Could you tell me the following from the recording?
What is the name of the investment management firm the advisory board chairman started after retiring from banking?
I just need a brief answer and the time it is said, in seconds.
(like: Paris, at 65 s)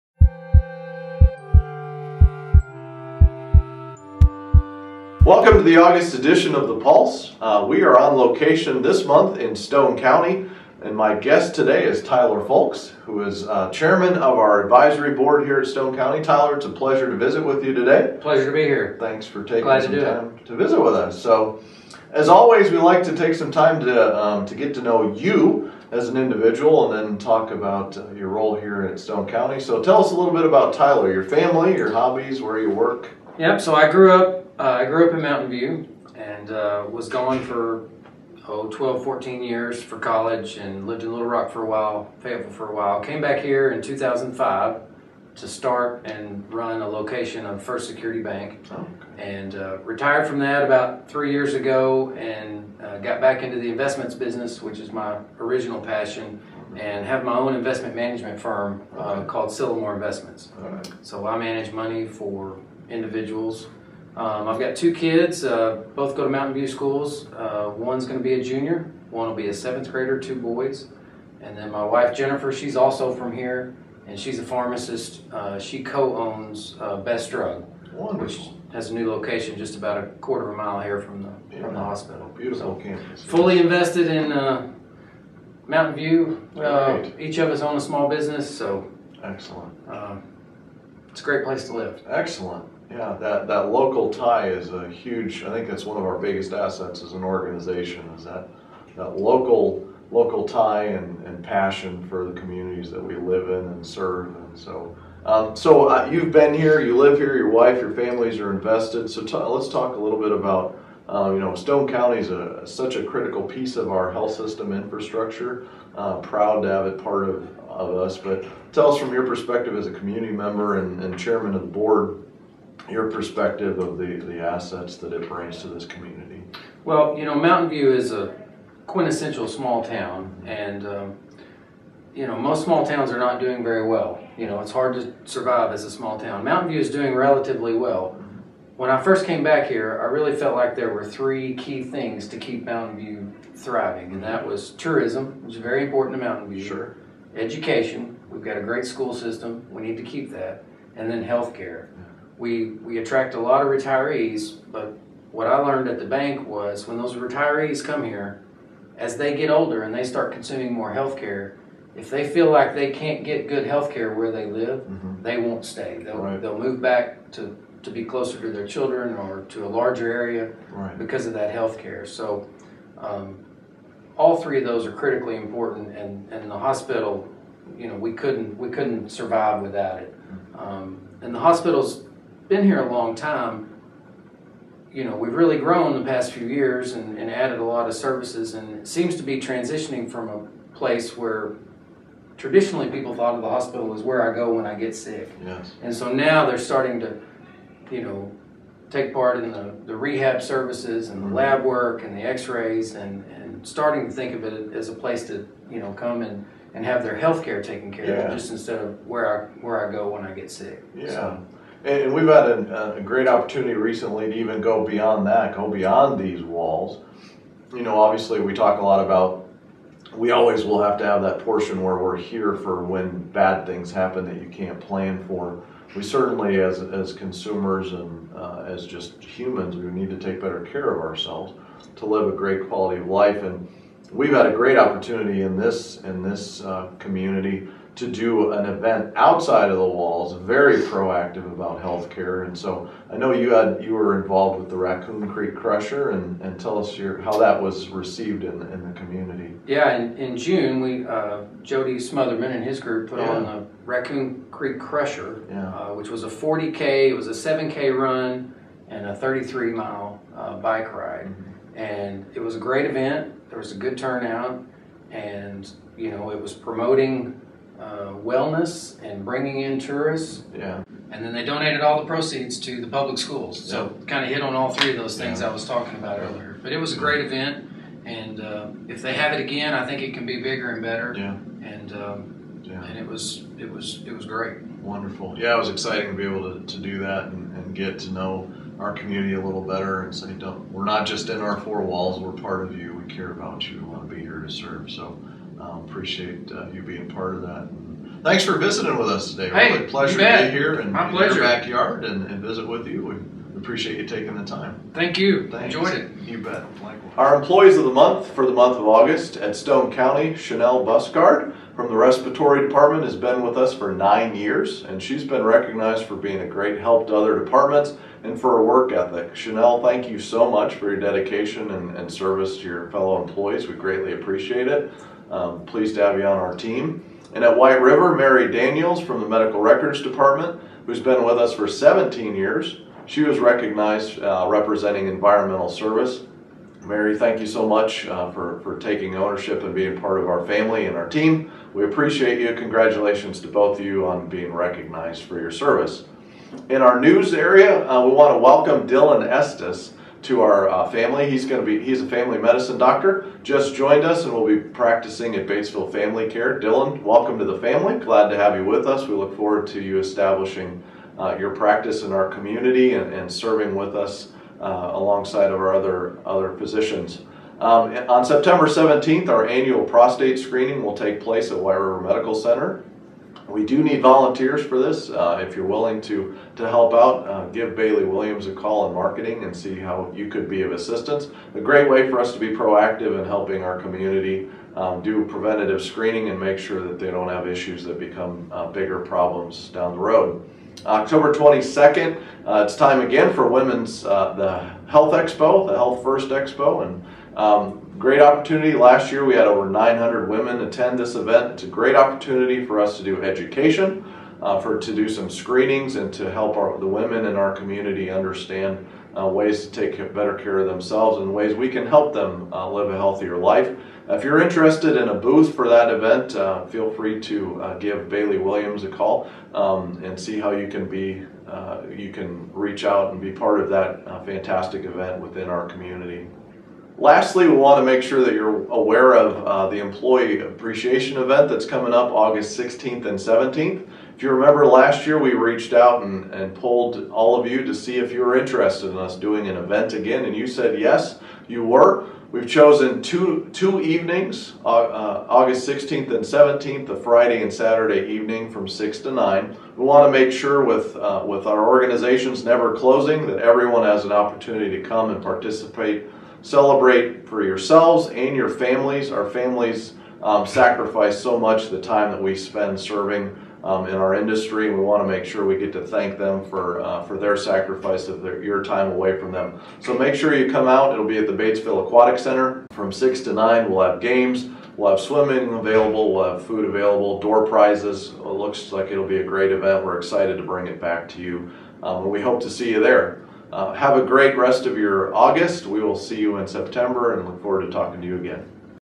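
Sylamore Investments, at 59 s.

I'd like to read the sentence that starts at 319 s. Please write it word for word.
Chanel, thank you so much for your dedication and, and service to your fellow employees.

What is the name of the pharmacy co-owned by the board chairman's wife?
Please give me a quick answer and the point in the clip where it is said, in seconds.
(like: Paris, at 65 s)
Best Drug, at 76 s.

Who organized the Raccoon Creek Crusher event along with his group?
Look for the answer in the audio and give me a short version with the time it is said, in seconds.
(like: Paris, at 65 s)
Jody Smotherman, at 251 s.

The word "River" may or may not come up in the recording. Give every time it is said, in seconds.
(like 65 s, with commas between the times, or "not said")
327 s, 371 s.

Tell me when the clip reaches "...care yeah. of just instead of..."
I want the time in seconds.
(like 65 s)
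207 s.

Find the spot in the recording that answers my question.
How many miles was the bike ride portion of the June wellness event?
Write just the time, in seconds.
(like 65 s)
259 s.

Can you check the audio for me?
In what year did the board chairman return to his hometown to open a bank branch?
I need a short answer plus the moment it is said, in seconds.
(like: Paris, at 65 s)
2005, at 43 s.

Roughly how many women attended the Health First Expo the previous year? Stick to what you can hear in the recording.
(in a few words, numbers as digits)
900.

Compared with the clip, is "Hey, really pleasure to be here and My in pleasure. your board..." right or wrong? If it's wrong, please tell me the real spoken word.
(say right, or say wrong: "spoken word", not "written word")
wrong: "backyard", not "board".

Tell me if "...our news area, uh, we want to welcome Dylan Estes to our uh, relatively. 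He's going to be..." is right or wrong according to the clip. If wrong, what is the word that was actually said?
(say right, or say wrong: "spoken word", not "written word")
wrong: "family", not "relatively".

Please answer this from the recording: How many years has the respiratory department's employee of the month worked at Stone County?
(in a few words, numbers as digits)
9.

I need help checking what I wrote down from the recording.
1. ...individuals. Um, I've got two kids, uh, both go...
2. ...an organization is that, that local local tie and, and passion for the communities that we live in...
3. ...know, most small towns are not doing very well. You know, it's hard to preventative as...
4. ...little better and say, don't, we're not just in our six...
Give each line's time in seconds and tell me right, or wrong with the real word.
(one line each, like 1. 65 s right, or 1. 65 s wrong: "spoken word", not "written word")
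1. 62 s right
2. 97 s right
3. 132 s wrong: "survive", not "preventative"
4. 289 s wrong: "four", not "six".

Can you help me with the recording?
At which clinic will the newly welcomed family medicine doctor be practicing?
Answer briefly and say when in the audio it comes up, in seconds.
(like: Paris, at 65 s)
Batesville Family Care, at 355 s.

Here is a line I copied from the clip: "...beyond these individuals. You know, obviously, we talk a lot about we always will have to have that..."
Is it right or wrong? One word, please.
wrong.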